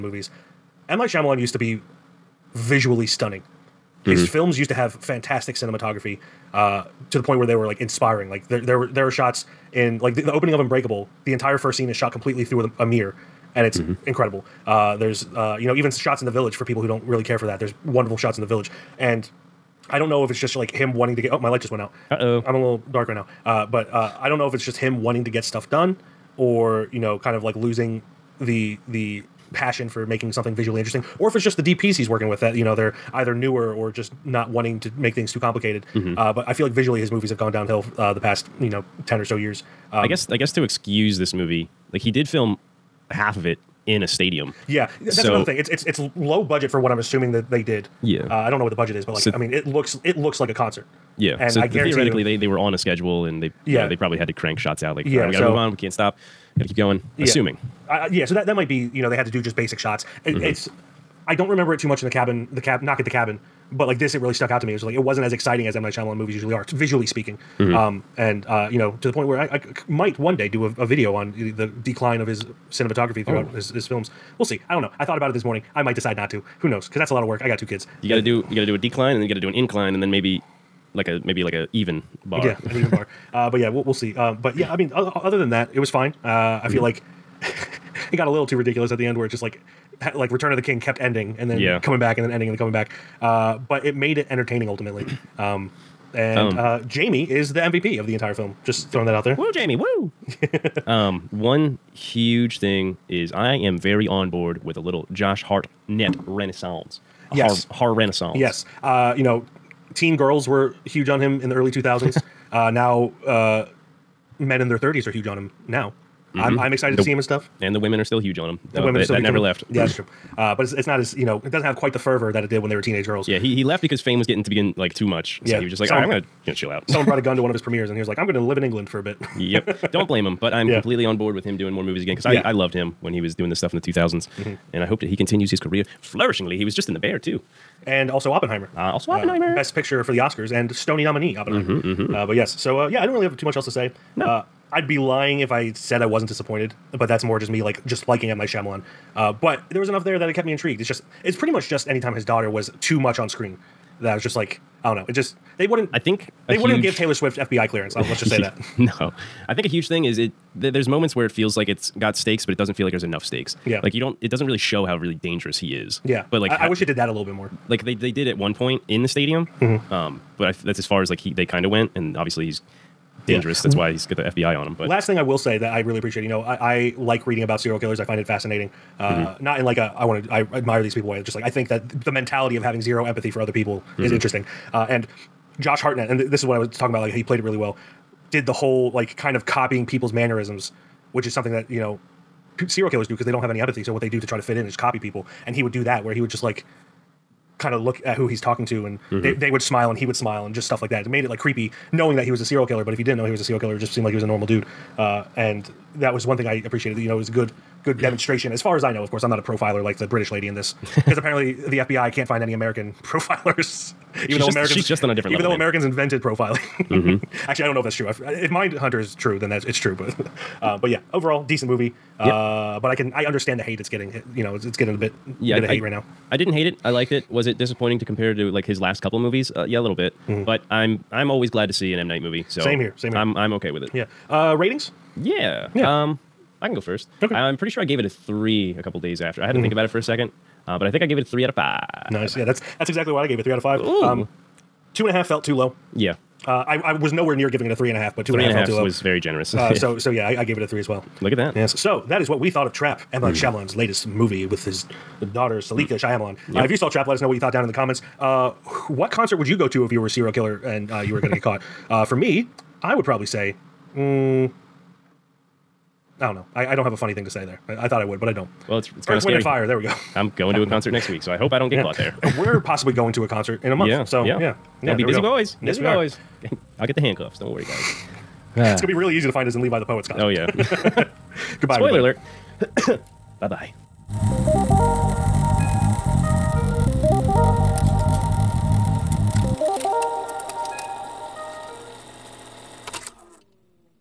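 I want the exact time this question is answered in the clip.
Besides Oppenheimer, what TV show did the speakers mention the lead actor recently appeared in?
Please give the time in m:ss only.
2:16.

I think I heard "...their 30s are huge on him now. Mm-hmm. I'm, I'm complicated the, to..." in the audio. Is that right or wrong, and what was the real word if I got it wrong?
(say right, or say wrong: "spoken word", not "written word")
wrong: "excited", not "complicated".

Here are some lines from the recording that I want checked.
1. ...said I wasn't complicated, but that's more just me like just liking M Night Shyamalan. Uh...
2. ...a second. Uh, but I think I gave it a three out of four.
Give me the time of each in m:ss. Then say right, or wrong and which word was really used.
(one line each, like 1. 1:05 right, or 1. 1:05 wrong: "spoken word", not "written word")
1. 2:25 wrong: "disappointed", not "complicated"
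2. 3:59 wrong: "five", not "four".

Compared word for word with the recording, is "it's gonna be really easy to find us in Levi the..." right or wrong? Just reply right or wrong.
right.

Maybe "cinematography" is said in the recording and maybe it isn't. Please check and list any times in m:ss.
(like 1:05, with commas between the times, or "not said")
0:05, 1:12.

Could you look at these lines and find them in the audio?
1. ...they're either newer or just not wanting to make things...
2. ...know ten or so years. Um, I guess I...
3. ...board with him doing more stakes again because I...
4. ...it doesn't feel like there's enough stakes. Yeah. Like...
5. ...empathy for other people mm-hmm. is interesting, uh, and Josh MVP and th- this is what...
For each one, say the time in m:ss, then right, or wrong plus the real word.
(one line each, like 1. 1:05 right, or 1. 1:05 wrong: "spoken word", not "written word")
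1. 0:32 right
2. 0:38 right
3. 2:11 wrong: "movies", not "stakes"
4. 2:42 right
5. 3:03 wrong: "Hartnett", not "MVP".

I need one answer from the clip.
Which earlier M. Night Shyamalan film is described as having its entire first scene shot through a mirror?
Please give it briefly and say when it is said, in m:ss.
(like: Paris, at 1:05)
Unbreakable, at 0:10.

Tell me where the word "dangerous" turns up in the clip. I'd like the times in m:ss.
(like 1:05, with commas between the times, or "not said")
2:45, 2:53.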